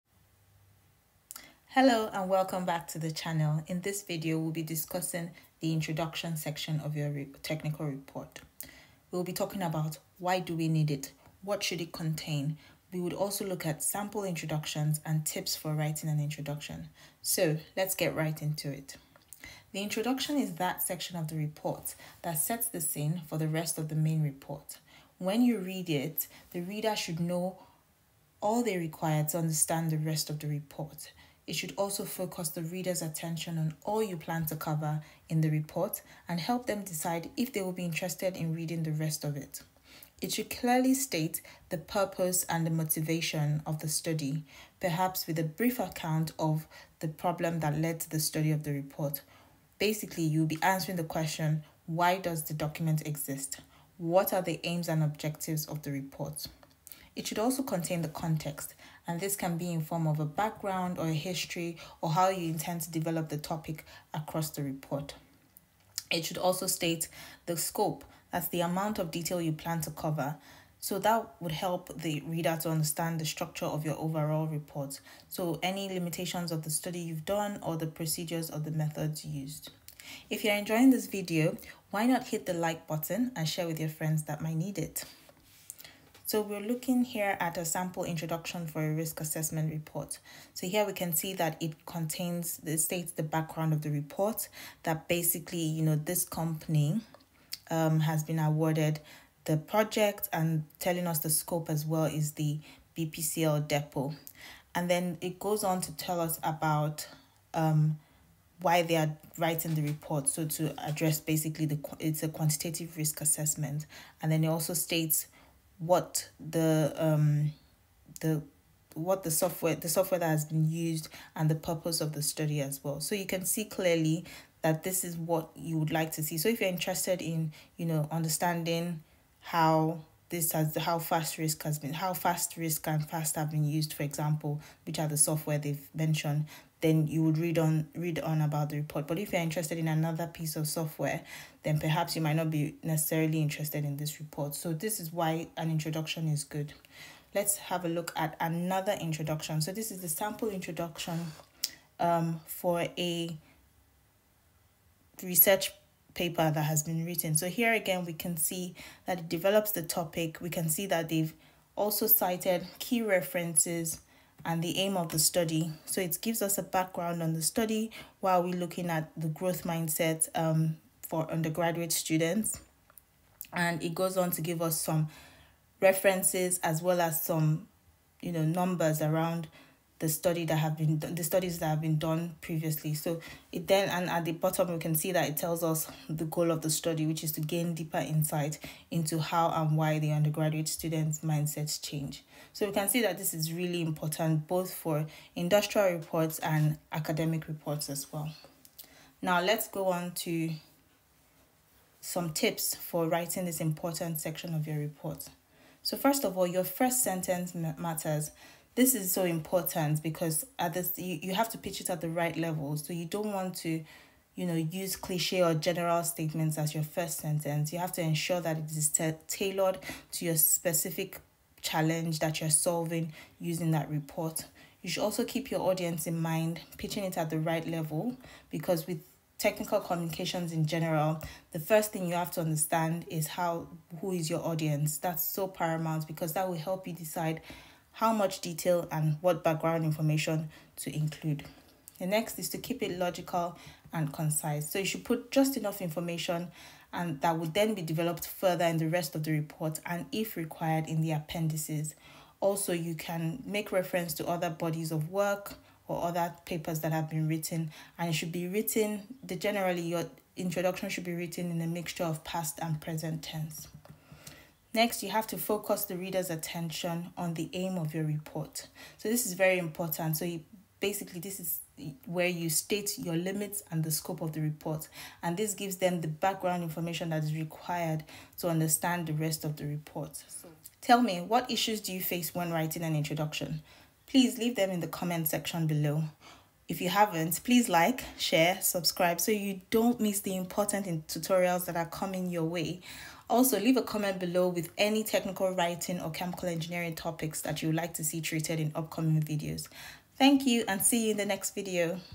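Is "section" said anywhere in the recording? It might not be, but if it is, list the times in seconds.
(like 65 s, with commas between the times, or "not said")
6 s, 20 s, 204 s, 285 s.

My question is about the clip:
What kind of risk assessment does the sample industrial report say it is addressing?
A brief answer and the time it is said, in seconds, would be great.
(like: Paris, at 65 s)
Quantitative, at 112 s.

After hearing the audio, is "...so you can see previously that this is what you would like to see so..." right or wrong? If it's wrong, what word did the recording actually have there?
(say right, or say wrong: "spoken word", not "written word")
wrong: "clearly", not "previously".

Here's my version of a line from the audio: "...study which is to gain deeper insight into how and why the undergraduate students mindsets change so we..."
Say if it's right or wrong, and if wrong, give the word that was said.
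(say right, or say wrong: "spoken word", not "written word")
right.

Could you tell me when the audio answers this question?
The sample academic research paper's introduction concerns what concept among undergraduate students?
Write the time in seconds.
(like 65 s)
169 s.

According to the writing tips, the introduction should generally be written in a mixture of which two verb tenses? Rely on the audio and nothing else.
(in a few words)
Past and present.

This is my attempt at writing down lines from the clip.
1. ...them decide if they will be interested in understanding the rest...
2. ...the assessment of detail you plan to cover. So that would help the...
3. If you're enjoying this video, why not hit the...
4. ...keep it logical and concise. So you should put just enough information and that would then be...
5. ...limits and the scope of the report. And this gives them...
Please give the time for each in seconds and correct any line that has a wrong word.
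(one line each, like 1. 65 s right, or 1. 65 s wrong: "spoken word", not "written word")
1. 36 s wrong: "reading", not "understanding"
2. 68 s wrong: "amount", not "assessment"
3. 80 s right
4. 242 s right
5. 273 s right.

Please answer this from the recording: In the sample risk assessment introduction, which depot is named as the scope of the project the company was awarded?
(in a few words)
BPCL depot.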